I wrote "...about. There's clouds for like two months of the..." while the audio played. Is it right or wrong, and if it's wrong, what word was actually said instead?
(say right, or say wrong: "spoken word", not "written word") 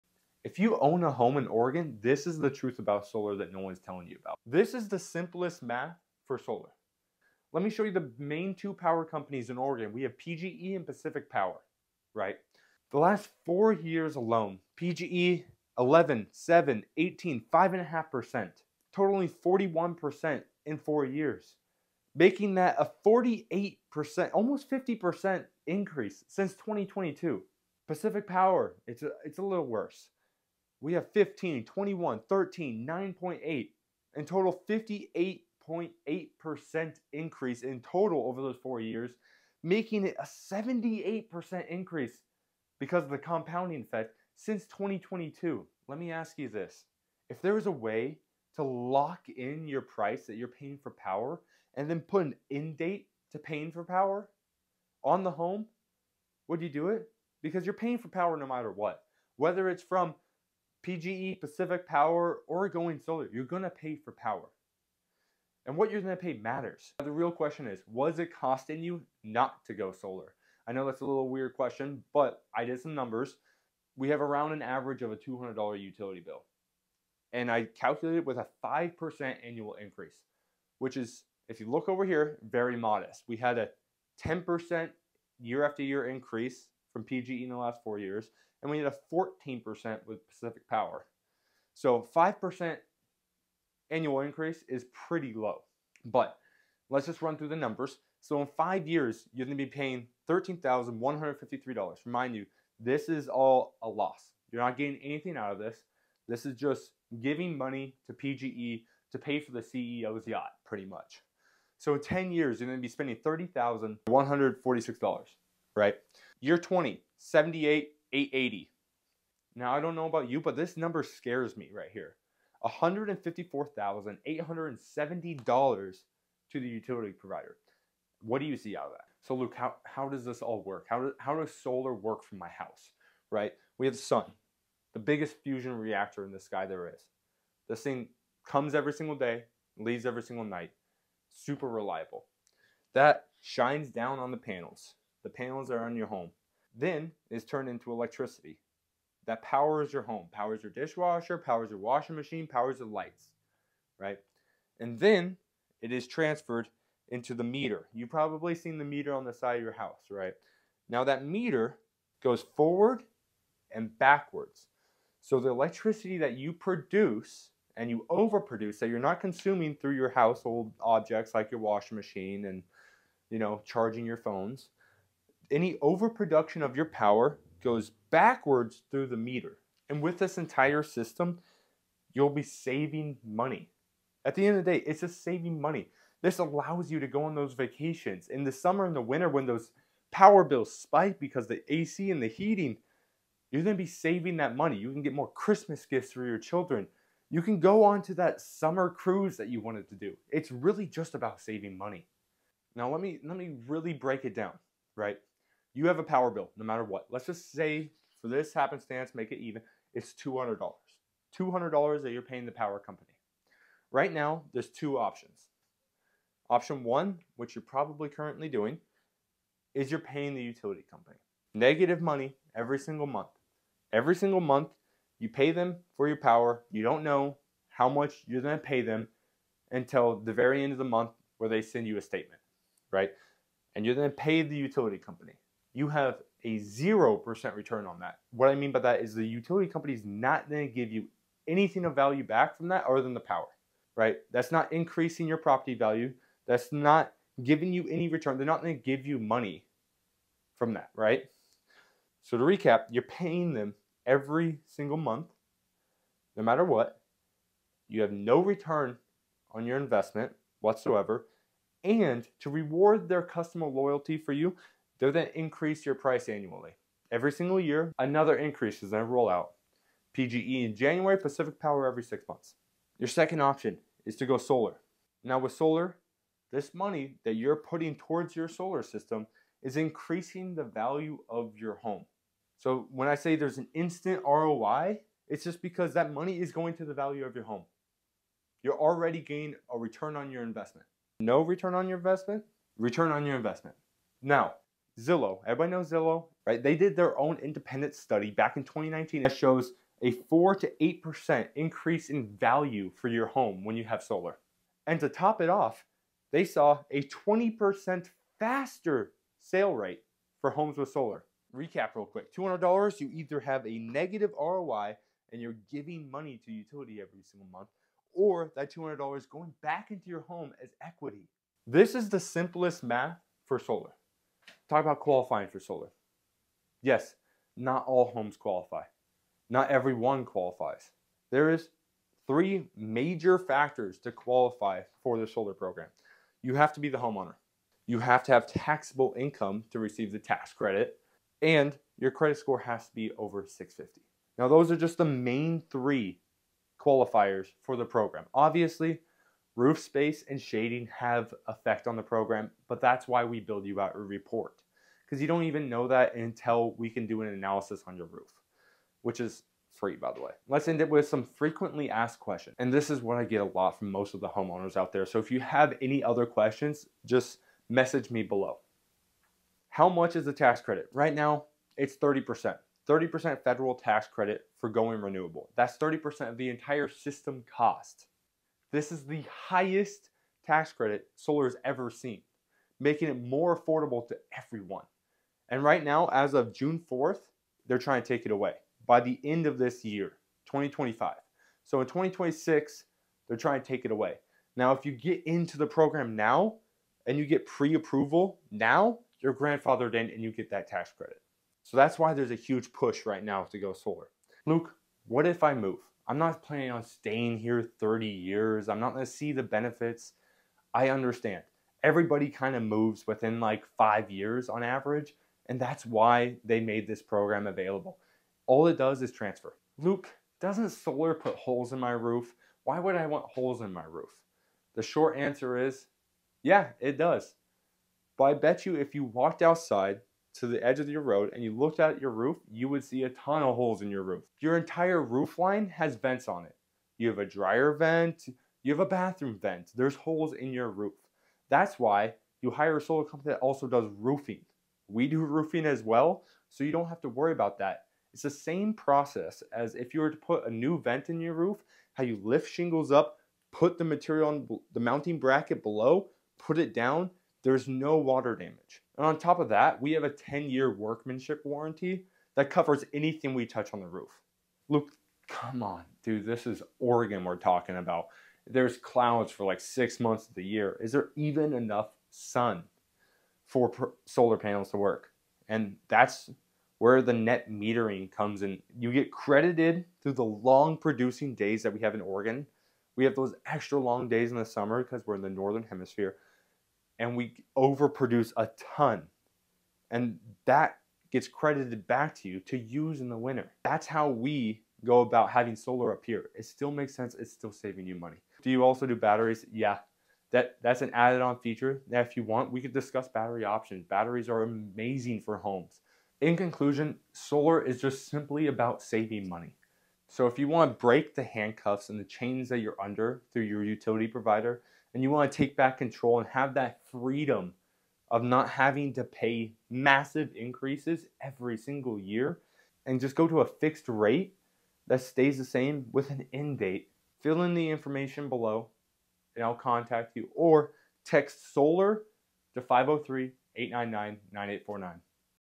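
wrong: "six", not "two".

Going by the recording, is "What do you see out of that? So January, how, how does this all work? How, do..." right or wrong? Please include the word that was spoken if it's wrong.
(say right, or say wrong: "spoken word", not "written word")
wrong: "Luke", not "January".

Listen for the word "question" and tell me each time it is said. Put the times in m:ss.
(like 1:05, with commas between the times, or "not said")
1:07, 1:11, 6:02, 6:06.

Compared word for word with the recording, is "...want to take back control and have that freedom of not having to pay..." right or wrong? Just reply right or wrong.
right.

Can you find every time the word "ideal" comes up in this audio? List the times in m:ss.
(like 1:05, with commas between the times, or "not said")
not said.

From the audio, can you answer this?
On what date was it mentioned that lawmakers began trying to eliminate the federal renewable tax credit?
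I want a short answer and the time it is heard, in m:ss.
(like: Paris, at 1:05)
June 4th, at 6:26.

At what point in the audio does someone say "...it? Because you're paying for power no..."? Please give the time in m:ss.
0:56.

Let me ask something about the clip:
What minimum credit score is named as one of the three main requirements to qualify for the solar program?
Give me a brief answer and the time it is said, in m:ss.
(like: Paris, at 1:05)
650, at 5:43.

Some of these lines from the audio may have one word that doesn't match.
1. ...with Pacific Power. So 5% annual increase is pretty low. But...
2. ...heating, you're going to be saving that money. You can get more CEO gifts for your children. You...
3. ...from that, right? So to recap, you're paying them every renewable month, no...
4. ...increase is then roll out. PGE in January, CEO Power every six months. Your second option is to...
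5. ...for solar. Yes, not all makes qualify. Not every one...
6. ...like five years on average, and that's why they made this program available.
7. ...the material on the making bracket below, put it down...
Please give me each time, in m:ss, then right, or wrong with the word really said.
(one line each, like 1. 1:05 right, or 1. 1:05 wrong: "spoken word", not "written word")
1. 1:30 right
2. 3:12 wrong: "Christmas", not "CEO"
3. 4:10 wrong: "single", not "renewable"
4. 4:28 wrong: "Pacific", not "CEO"
5. 5:25 wrong: "homes", not "makes"
6. 6:53 right
7. 7:33 wrong: "mounting", not "making".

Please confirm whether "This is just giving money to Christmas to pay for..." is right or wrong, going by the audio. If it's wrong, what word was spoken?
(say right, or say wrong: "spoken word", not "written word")
wrong: "PGE", not "Christmas".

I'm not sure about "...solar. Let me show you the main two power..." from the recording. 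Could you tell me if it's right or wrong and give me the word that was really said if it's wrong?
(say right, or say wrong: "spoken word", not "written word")
right.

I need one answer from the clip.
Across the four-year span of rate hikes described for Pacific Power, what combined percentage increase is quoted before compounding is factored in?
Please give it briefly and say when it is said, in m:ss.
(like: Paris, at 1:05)
58.8%, at 0:34.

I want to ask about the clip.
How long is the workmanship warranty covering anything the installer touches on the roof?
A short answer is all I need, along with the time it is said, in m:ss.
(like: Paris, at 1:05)
10 years, at 7:40.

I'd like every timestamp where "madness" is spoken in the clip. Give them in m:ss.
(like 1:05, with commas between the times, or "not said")
not said.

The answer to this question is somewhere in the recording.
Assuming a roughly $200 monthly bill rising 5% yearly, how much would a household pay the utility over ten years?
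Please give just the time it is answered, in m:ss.
1:53.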